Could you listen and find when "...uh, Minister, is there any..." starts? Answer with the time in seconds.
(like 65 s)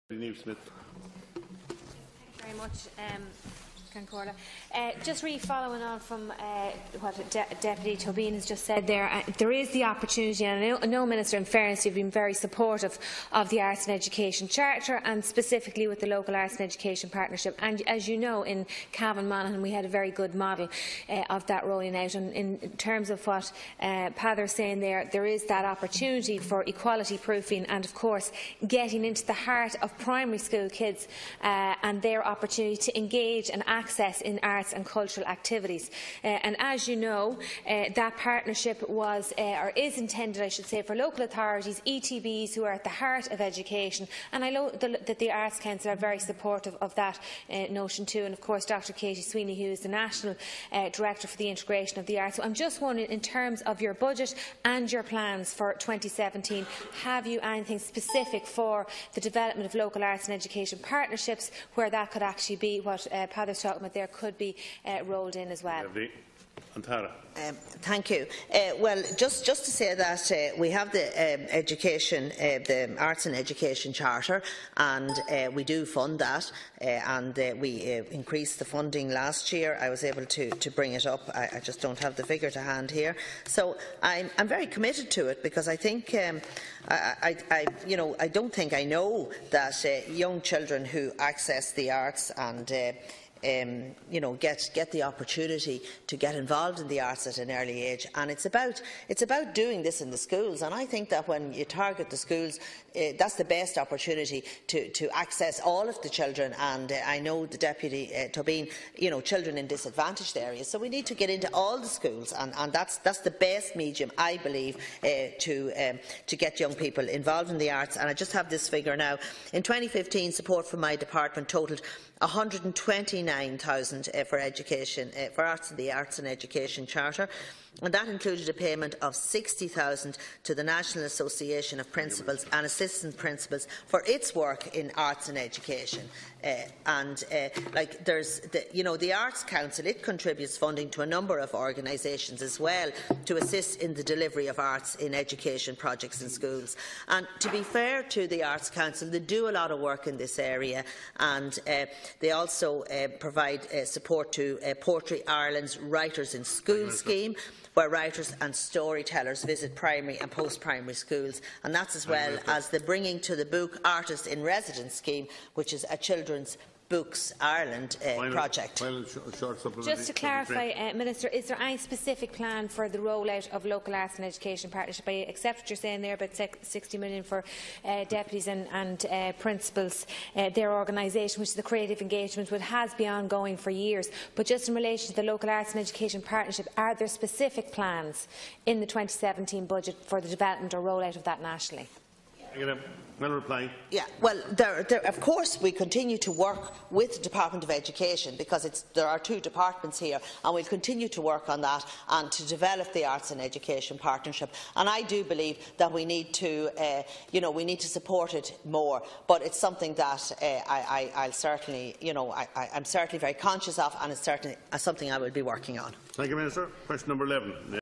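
170 s.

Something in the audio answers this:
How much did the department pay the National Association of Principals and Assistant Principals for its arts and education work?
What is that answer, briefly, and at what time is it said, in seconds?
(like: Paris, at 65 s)
60,000, at 129 s.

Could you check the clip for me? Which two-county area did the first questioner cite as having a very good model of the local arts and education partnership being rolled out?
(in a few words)
Cavan Monaghan.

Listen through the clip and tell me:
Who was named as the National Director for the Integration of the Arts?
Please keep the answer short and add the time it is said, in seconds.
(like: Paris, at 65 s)
Dr. Katie Sweeney, at 48 s.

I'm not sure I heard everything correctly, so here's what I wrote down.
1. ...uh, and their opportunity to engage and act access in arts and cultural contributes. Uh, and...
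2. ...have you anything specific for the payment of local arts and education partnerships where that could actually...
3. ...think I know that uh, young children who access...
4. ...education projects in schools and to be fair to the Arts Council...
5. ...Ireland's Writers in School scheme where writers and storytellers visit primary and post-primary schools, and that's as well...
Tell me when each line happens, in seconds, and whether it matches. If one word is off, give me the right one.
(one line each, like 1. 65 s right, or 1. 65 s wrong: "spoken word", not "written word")
1. 31 s wrong: "activities", not "contributes"
2. 57 s wrong: "development", not "payment"
3. 88 s right
4. 145 s right
5. 155 s right.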